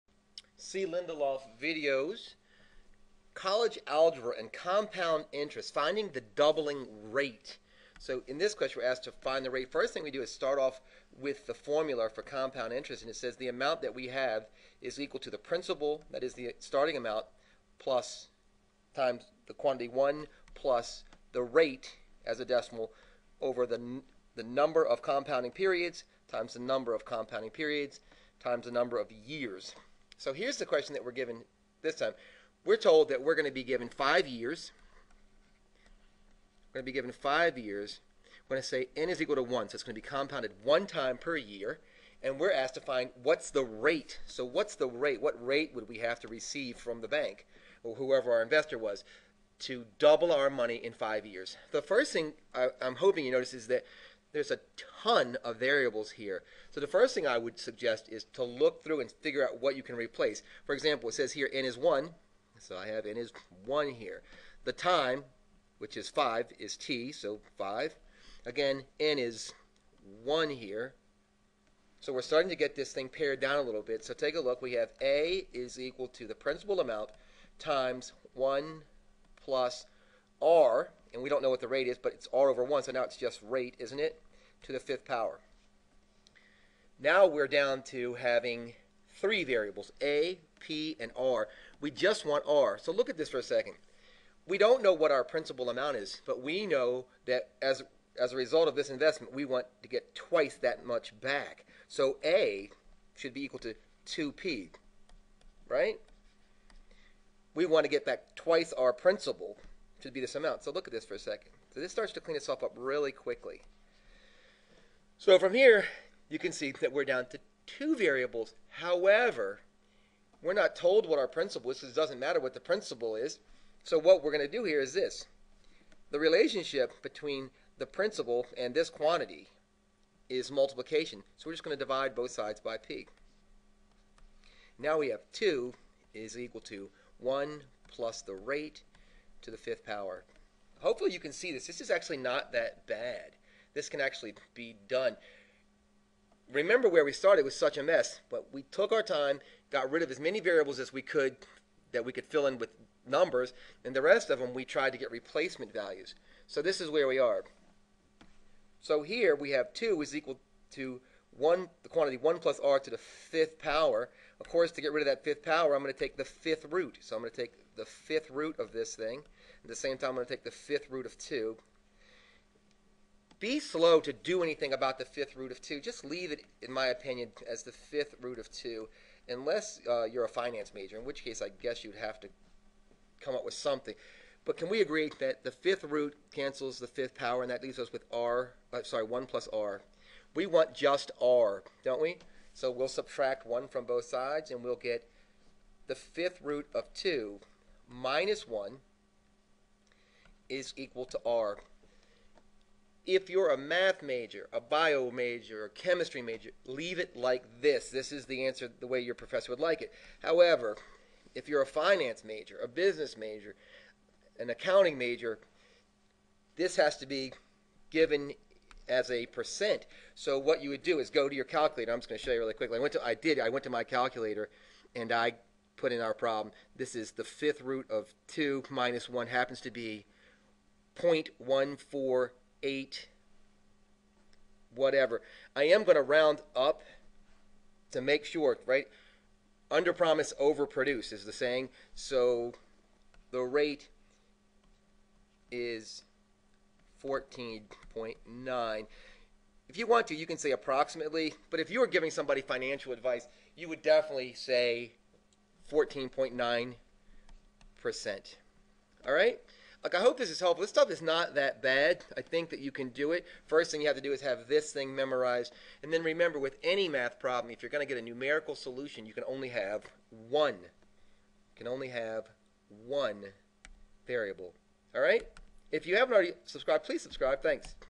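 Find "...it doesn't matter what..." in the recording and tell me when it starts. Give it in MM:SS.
02:01.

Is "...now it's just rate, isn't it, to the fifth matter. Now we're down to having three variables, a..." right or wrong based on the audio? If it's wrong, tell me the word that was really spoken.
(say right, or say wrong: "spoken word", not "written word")
wrong: "power", not "matter".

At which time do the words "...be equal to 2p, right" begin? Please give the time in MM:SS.
01:43.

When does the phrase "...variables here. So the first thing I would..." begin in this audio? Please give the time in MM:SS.
00:55.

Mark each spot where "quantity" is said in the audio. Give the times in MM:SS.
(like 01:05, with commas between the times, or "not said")
00:19, 02:08, 02:41.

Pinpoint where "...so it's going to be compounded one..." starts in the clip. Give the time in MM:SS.
00:39.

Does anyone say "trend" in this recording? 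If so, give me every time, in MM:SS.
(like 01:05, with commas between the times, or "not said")
not said.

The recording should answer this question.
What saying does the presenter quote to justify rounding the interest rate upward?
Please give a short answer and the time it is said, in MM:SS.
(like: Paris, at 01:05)
Under promise, over produce, at 03:59.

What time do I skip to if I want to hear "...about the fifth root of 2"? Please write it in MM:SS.
02:54.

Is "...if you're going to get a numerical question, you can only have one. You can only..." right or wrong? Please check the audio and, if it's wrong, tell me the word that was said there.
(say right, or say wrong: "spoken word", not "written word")
wrong: "solution", not "question".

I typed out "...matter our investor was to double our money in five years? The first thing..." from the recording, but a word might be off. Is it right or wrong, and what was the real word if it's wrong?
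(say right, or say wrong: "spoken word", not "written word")
wrong: "whoever", not "matter".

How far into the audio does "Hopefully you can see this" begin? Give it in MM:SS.
02:20.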